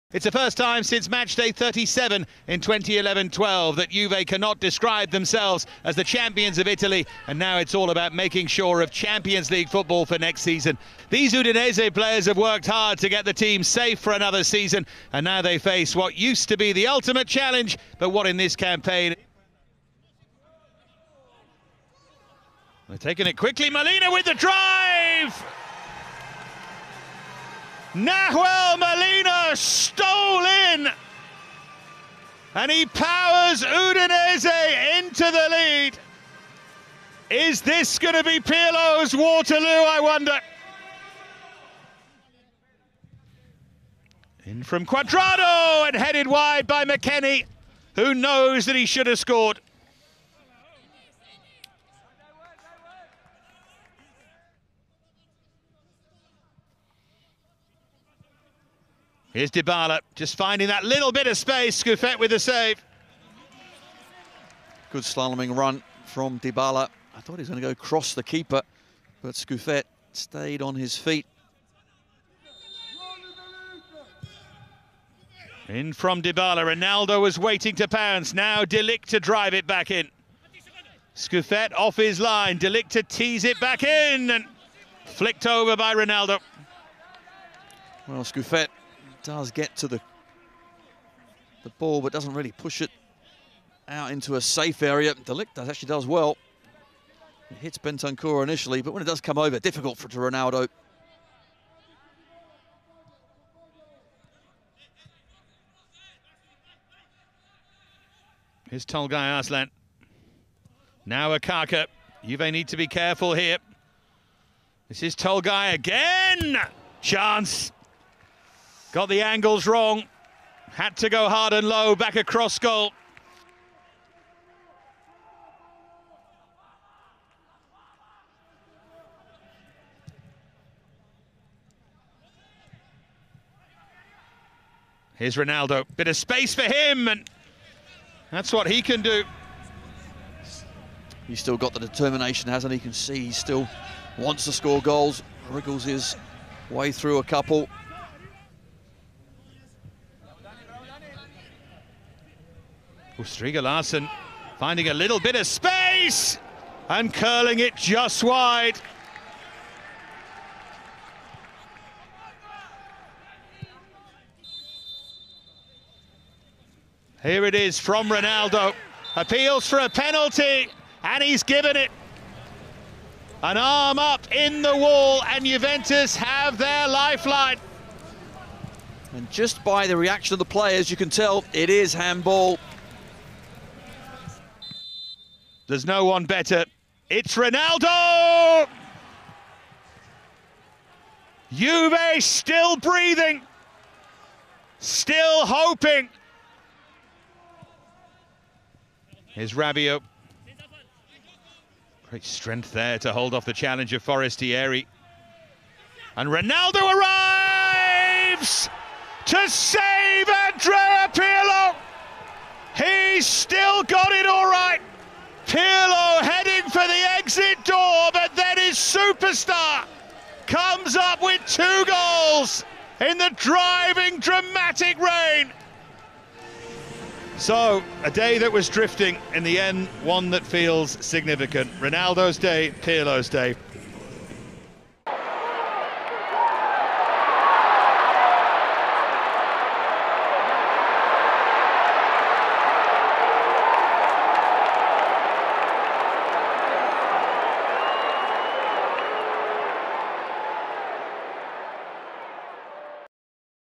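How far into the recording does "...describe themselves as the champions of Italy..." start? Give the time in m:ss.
0:04.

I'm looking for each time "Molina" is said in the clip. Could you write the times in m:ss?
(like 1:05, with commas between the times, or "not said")
0:23, 0:28.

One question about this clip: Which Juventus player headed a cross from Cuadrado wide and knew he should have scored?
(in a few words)
McKennie.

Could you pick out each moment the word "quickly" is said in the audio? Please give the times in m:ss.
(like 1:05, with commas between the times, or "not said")
0:23.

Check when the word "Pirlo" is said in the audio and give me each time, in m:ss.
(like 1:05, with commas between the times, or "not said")
0:38, 3:31, 3:35, 3:52.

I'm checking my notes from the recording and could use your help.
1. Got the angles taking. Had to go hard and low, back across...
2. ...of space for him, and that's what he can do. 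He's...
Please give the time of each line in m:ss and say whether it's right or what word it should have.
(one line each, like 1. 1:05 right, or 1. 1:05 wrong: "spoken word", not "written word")
1. 1:58 wrong: "wrong", not "taking"
2. 2:16 right.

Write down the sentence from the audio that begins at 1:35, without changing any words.
De Ligt does, actually does well.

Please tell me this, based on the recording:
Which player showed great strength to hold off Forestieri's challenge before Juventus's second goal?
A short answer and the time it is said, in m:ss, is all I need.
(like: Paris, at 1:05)
Rabiot, at 3:19.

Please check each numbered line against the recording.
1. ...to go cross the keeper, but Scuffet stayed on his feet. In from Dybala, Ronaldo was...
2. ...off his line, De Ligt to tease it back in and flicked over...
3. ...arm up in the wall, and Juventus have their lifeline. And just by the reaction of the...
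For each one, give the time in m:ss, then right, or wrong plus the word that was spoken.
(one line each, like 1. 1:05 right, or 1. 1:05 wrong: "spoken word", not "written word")
1. 1:07 right
2. 1:21 right
3. 2:53 right.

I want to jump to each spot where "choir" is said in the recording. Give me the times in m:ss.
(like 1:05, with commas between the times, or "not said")
not said.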